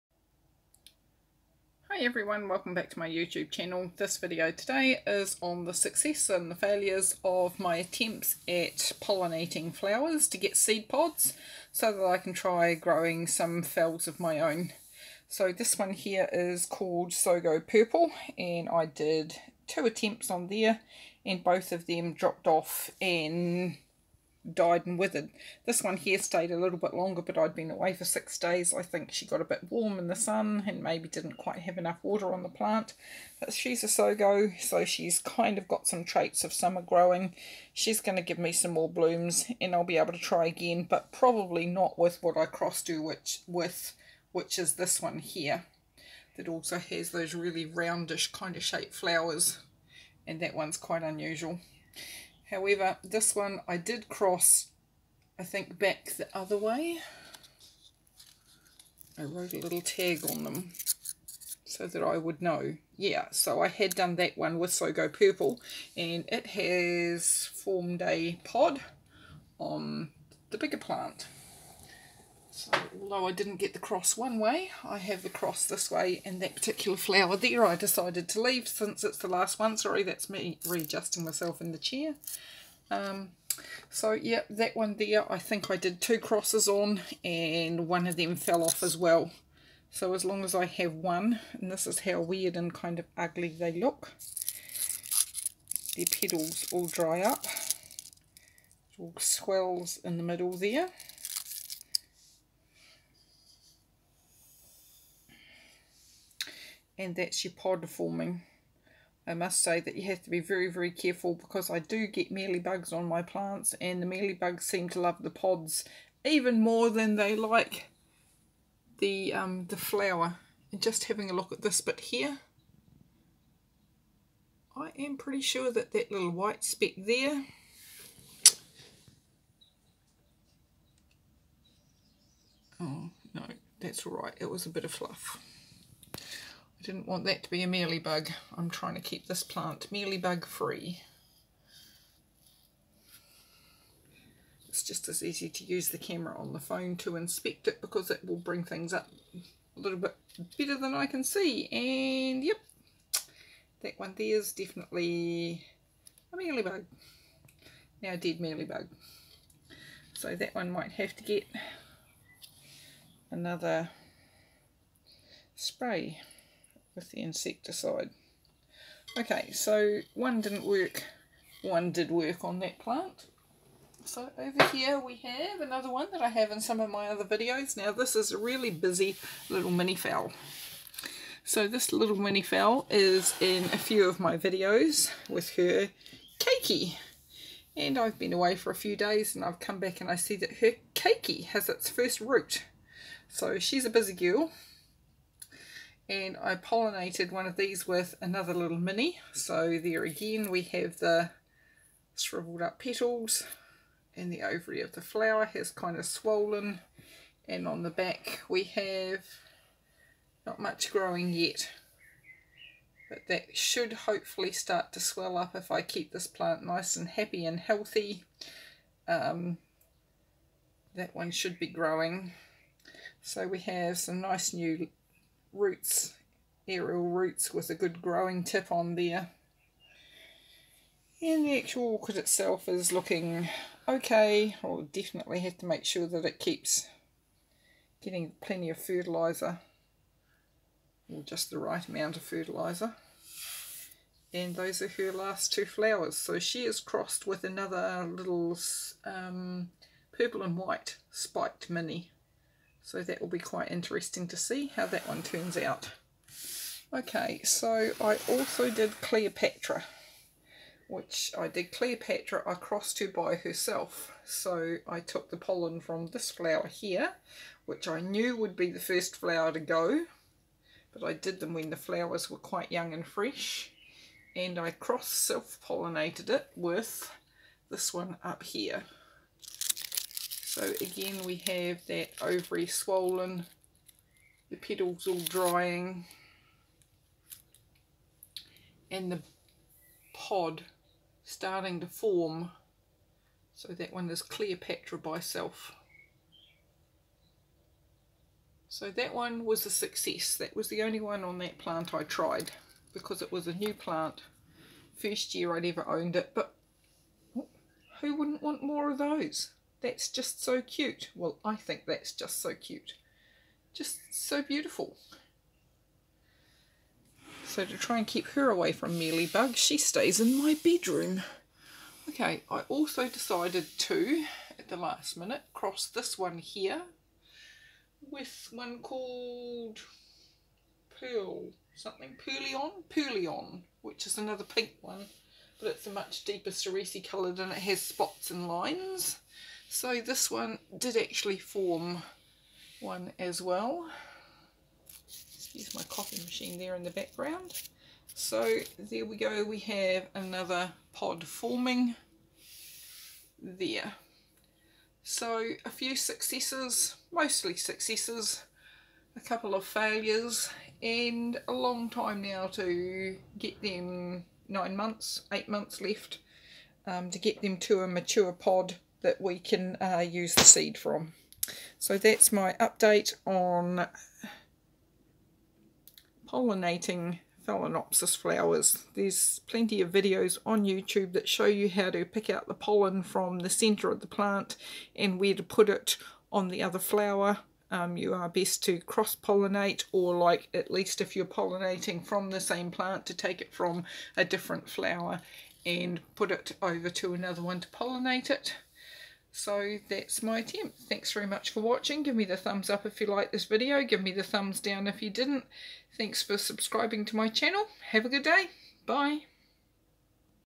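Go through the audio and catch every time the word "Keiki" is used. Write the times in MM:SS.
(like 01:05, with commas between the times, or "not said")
03:06, 03:10.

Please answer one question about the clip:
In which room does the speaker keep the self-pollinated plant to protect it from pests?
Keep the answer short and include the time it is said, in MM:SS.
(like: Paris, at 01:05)
Bedroom, at 05:20.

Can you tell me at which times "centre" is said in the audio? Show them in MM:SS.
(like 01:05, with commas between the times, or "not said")
06:23.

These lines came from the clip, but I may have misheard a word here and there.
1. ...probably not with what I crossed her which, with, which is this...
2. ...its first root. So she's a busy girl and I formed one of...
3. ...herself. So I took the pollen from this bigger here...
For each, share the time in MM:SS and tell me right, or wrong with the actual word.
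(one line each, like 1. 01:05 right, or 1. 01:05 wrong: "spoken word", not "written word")
1. 00:41 right
2. 03:11 wrong: "pollinated", not "formed"
3. 04:23 wrong: "flower", not "bigger".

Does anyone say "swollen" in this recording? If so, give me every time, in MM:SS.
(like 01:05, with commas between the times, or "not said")
03:26, 04:42.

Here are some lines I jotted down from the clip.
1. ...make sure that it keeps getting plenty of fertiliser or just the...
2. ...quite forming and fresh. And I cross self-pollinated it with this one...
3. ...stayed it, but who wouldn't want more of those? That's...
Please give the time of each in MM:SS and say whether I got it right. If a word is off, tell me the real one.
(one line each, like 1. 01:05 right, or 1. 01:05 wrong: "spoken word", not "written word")
1. 03:55 right
2. 04:32 wrong: "young", not "forming"
3. 05:05 wrong: "owned", not "stayed".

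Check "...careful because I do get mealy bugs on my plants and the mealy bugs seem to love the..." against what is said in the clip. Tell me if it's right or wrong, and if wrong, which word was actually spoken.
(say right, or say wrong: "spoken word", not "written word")
right.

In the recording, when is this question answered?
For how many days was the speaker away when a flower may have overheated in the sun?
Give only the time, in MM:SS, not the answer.
00:28.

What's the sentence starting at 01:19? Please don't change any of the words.
Sorry, that's me readjusting myself in the chair.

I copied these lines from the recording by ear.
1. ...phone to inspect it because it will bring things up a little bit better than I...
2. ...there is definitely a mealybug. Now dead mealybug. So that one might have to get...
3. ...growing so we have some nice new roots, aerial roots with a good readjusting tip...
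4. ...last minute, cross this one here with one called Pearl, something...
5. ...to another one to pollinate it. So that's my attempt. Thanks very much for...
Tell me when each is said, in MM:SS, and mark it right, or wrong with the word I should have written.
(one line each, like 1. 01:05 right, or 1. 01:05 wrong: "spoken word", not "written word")
1. 02:26 right
2. 02:34 right
3. 03:41 wrong: "growing", not "readjusting"
4. 05:24 right
5. 06:36 right.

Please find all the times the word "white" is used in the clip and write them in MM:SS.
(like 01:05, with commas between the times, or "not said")
02:06, 04:10.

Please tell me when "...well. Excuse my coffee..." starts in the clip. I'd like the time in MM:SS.
05:43.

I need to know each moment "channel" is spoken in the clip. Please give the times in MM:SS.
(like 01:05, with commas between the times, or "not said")
00:03, 06:47.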